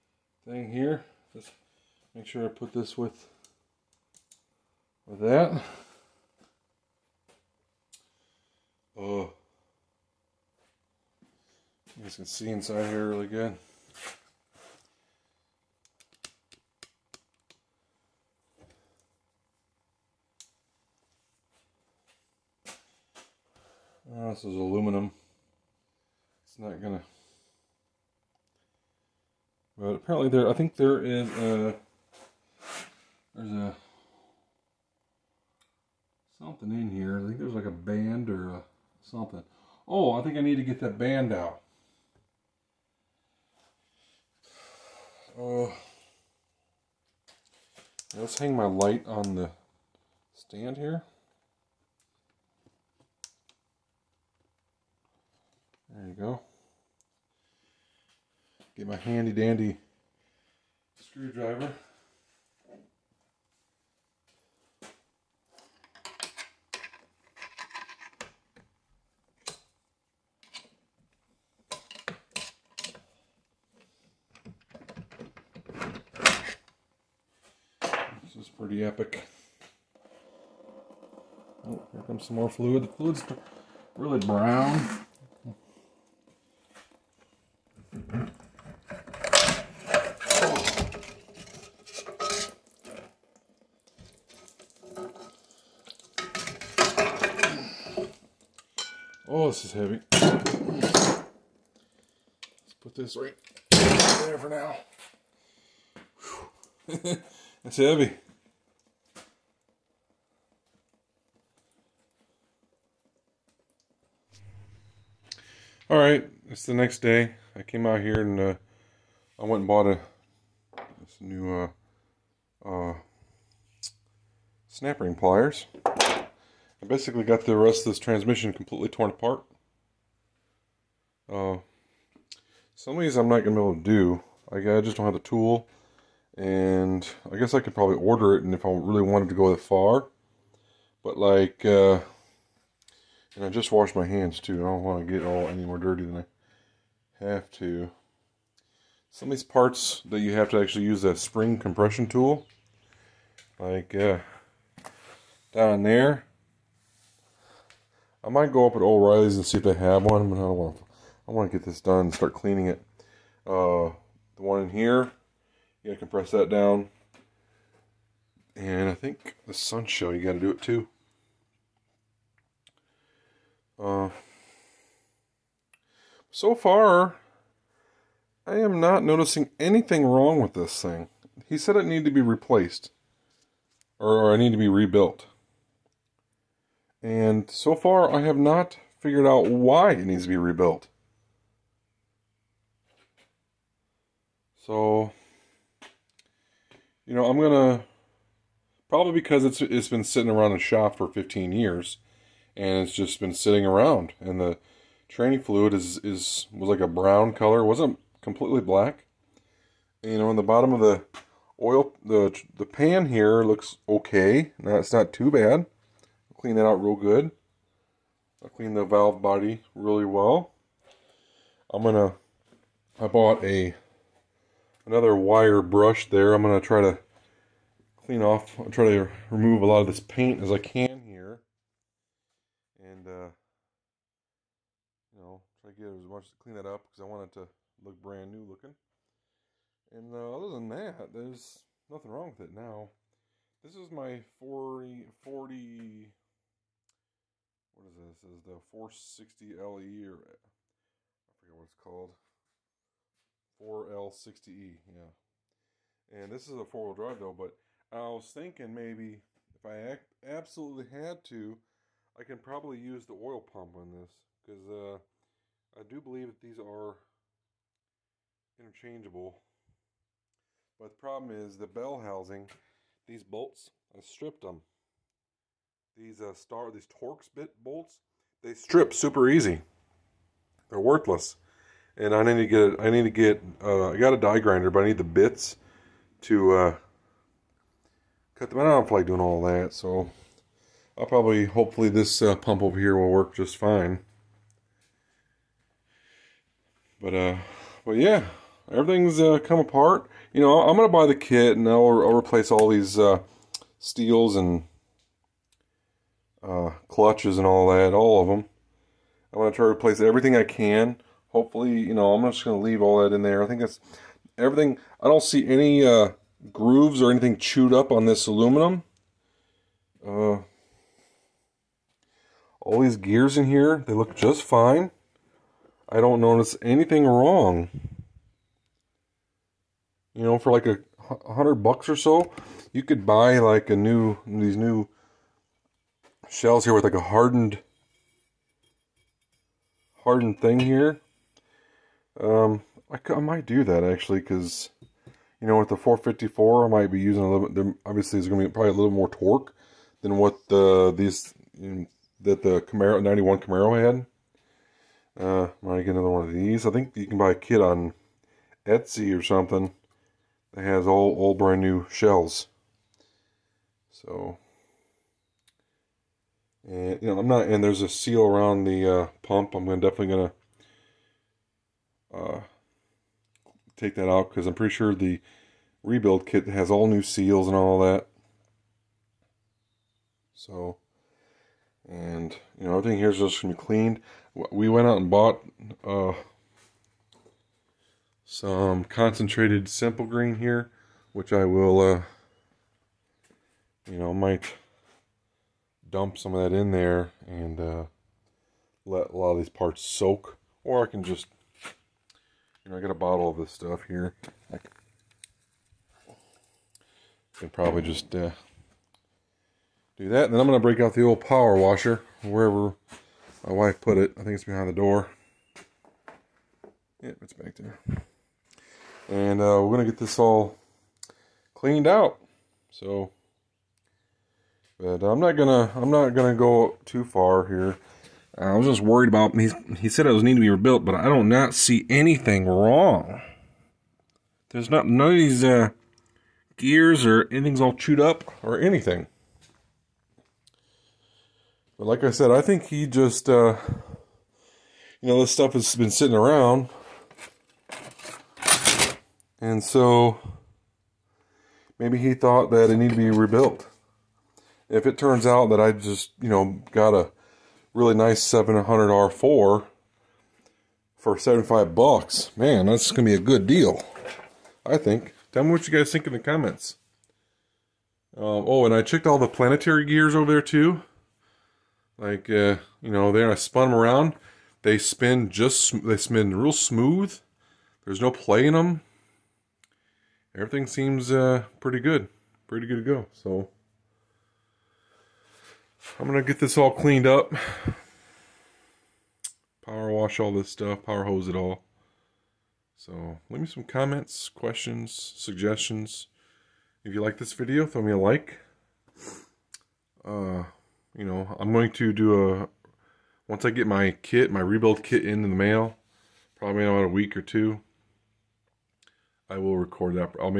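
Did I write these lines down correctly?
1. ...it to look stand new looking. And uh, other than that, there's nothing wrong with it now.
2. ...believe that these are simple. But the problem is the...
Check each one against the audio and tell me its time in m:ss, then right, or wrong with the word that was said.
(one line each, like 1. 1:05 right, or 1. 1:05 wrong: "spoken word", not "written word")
1. 3:57 wrong: "brand", not "stand"
2. 4:26 wrong: "interchangeable", not "simple".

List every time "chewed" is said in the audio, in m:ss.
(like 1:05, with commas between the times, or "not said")
5:17, 7:17.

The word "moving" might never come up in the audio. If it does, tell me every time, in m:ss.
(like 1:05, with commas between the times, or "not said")
not said.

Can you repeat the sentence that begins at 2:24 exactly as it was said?
I don't want to get all any more dirty than I have to.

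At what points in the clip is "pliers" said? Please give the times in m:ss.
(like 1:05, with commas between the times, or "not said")
2:05.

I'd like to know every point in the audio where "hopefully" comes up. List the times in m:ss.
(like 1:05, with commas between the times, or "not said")
4:51, 5:11.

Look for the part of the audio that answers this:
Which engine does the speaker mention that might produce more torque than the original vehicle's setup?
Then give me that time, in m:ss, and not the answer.
5:45.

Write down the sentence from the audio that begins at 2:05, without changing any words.
I basically got the rest of this transmission completely torn apart.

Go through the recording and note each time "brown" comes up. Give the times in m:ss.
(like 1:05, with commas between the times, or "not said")
1:24, 3:26.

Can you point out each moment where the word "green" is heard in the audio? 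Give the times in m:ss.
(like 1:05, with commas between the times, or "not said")
6:30.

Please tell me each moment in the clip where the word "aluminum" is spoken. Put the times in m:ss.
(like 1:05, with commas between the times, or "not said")
0:24, 5:18.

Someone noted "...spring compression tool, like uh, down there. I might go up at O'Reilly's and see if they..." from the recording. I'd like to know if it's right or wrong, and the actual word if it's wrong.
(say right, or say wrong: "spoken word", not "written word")
right.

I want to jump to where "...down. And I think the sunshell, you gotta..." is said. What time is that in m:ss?
2:46.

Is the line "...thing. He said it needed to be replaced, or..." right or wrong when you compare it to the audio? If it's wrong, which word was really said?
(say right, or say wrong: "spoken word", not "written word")
right.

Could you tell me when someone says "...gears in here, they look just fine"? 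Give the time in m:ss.
5:22.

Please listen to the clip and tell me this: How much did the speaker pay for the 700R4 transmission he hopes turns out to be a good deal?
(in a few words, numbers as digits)
$75.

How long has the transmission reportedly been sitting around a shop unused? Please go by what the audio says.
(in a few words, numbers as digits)
15 years.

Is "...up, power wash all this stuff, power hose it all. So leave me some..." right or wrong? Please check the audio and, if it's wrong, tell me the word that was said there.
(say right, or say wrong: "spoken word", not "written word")
right.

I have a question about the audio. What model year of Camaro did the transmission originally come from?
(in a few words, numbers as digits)
1991.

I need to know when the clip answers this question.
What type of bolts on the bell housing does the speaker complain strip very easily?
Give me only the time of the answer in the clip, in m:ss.
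4:36.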